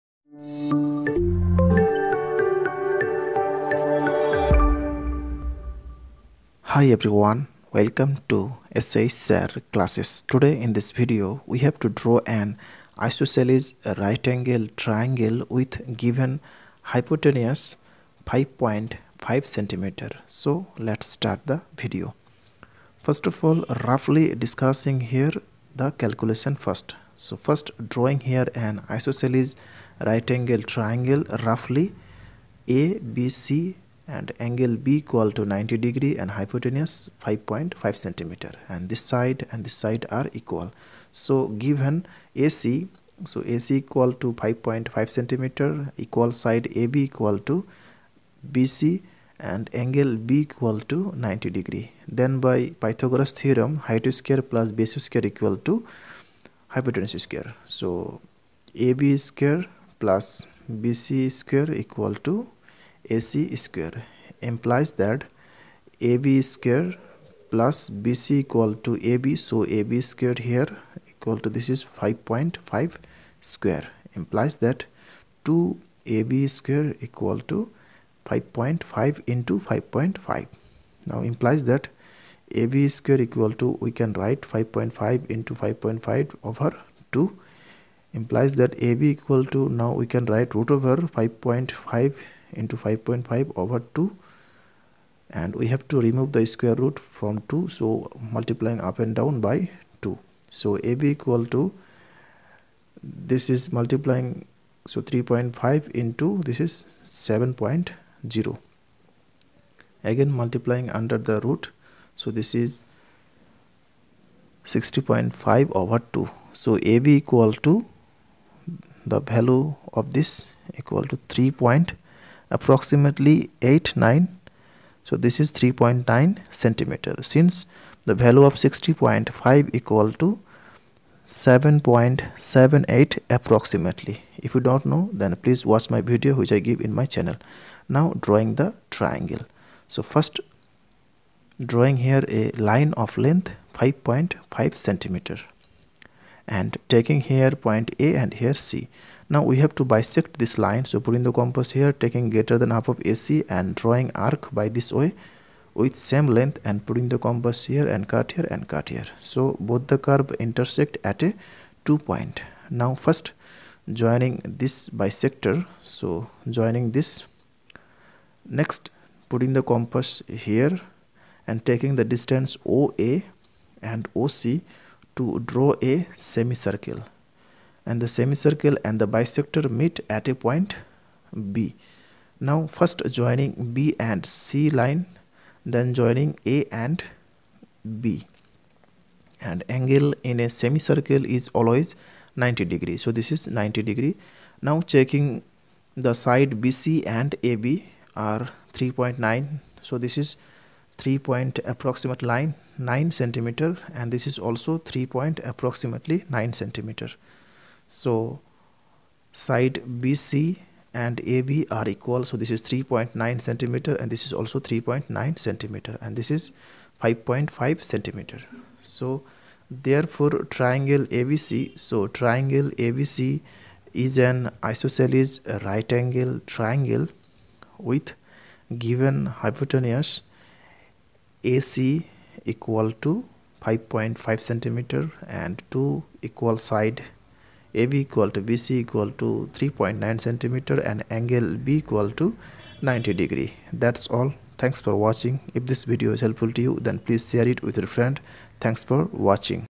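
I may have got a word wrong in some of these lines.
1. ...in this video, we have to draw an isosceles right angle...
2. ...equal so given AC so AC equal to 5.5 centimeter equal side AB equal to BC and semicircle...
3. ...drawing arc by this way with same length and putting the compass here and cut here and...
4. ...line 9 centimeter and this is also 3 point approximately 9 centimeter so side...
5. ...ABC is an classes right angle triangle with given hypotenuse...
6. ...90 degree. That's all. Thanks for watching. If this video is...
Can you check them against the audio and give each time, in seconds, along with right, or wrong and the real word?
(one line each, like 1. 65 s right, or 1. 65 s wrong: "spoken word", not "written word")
1. 10 s right
2. 40 s wrong: "angle", not "semicircle"
3. 153 s right
4. 202 s right
5. 222 s wrong: "isosceles", not "classes"
6. 242 s right.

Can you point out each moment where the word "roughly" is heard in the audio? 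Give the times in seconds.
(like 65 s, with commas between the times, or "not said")
23 s, 31 s.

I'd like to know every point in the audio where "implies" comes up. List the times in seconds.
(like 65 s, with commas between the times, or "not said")
64 s, 74 s, 81 s, 88 s.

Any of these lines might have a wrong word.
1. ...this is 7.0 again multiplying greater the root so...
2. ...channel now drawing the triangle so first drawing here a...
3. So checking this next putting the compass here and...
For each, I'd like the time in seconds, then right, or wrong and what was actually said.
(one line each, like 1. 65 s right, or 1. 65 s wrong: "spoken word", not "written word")
1. 106 s wrong: "under", not "greater"
2. 137 s right
3. 165 s wrong: "joining", not "checking".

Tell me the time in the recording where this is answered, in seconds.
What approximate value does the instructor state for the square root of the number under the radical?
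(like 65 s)
131 s.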